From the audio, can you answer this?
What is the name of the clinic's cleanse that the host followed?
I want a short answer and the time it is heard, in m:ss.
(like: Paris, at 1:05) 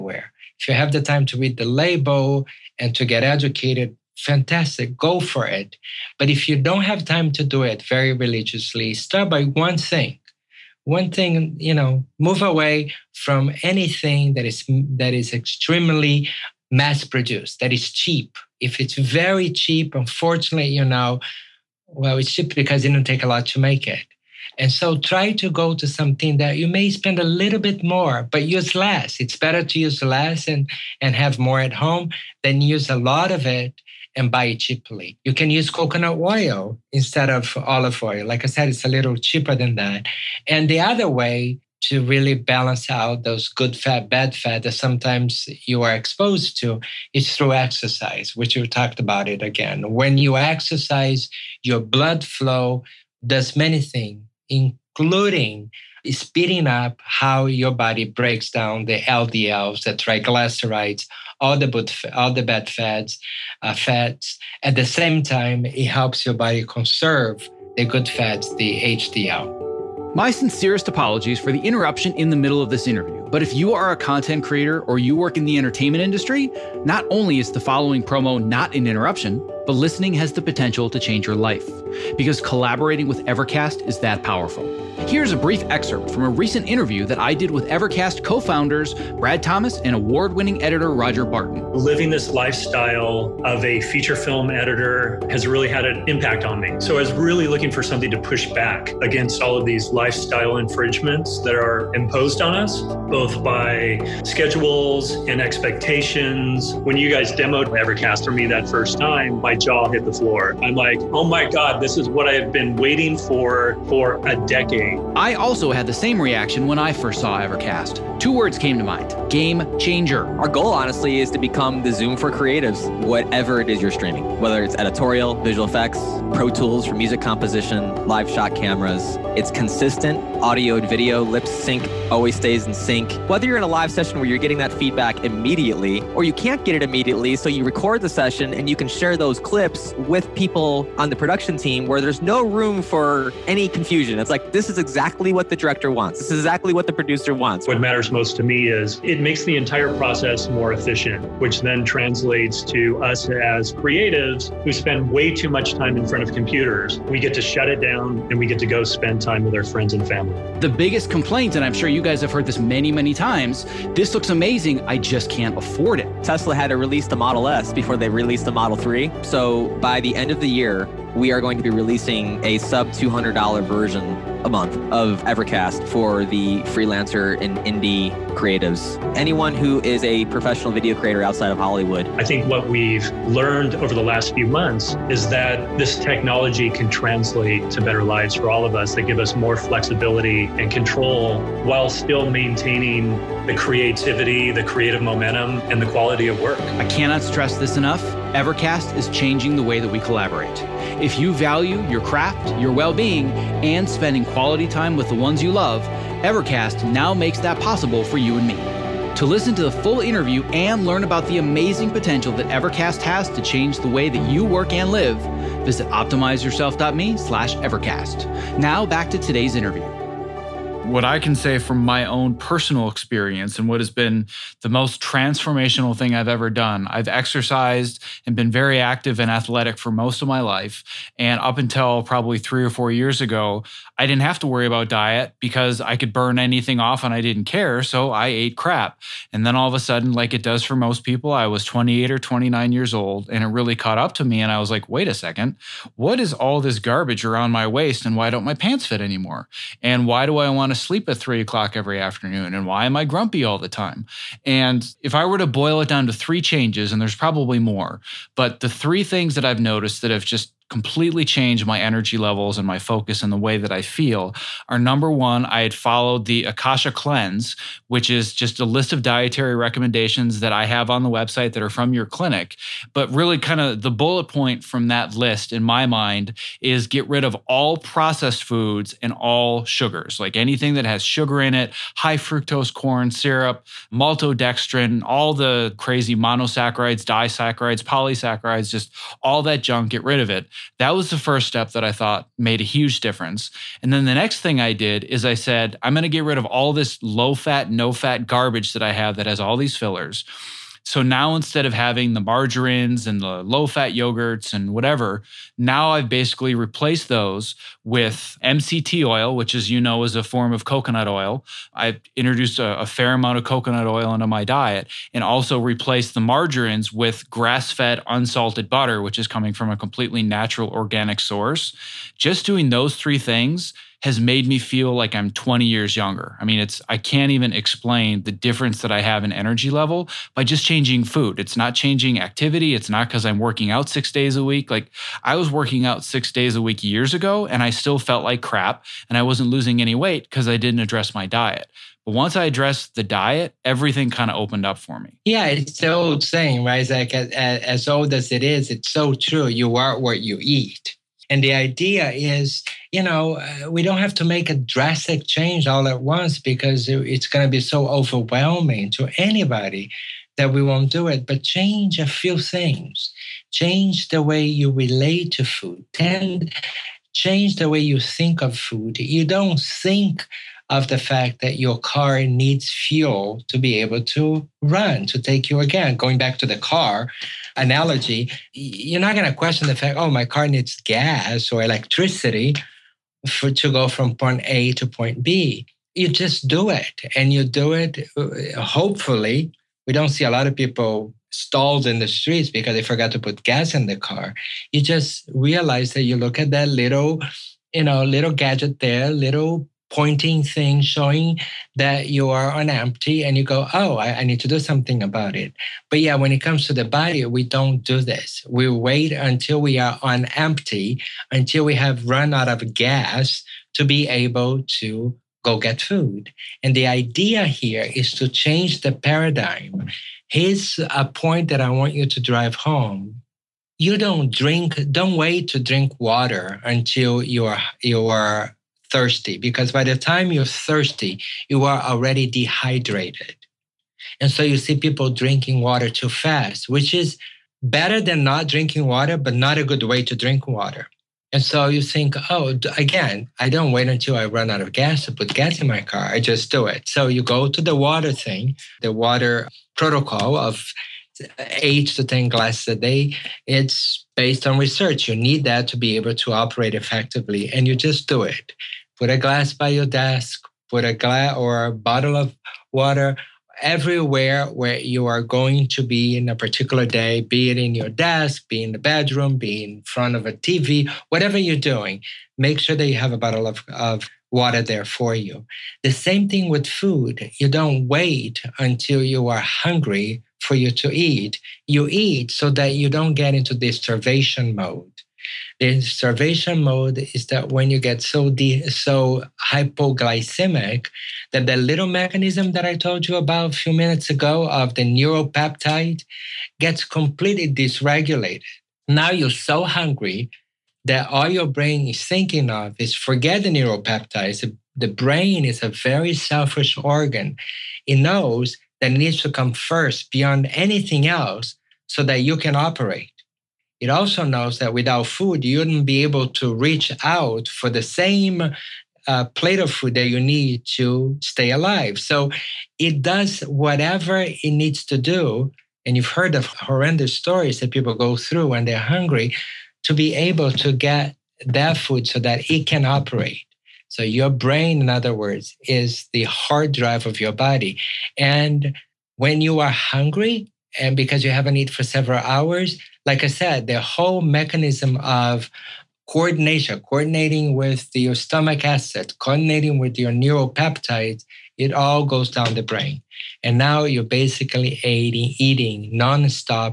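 Akasha Cleanse, at 4:26.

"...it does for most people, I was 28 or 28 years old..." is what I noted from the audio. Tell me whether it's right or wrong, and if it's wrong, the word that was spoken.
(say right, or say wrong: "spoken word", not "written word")
wrong: "29", not "28".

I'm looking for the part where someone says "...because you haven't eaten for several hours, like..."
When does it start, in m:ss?
9:00.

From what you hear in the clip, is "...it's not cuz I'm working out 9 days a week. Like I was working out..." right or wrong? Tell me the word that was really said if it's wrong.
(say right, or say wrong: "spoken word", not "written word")
wrong: "6", not "9".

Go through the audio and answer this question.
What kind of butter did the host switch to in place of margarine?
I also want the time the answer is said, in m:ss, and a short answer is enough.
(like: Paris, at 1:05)
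grass fed unsalted butter, at 5:17.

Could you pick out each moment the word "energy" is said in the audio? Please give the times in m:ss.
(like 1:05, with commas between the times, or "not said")
4:21, 5:29.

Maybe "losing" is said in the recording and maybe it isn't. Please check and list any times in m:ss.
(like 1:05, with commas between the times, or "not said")
5:39.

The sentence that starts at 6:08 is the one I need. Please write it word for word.
You don't think of the fact that your car needs fuel to be able to run, to take you again.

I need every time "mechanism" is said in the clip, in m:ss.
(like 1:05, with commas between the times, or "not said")
8:11, 9:04.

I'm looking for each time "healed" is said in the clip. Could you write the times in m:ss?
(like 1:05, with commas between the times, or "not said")
not said.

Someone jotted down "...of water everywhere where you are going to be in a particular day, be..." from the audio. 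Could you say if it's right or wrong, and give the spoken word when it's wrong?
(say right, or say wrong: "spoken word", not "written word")
right.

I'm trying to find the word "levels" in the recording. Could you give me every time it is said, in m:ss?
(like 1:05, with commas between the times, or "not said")
4:22, 5:29.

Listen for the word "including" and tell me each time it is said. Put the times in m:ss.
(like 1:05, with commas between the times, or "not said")
0:54.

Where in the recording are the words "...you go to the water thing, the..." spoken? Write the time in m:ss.
7:27.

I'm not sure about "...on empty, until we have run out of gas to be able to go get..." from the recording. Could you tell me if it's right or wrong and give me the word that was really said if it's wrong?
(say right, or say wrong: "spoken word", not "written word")
right.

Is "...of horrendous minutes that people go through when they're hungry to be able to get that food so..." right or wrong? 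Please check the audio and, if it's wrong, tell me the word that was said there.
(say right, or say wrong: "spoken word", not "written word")
wrong: "stories", not "minutes".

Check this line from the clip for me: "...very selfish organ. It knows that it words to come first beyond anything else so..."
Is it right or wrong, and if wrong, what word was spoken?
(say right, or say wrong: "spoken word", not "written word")
wrong: "needs", not "words".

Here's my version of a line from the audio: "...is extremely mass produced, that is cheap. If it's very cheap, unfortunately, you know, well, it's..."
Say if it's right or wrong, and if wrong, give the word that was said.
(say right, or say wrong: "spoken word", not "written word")
right.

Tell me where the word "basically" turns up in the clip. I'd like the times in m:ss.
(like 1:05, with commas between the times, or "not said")
5:06, 9:14.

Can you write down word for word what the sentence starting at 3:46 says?
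I've exercised and been very active and athletic for most of my life.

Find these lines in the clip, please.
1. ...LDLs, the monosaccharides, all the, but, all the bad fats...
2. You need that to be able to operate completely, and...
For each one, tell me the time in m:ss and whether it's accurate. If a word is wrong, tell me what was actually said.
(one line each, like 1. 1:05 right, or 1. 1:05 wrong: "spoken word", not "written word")
1. 0:59 wrong: "triglycerides", not "monosaccharides"
2. 7:35 wrong: "effectively", not "completely".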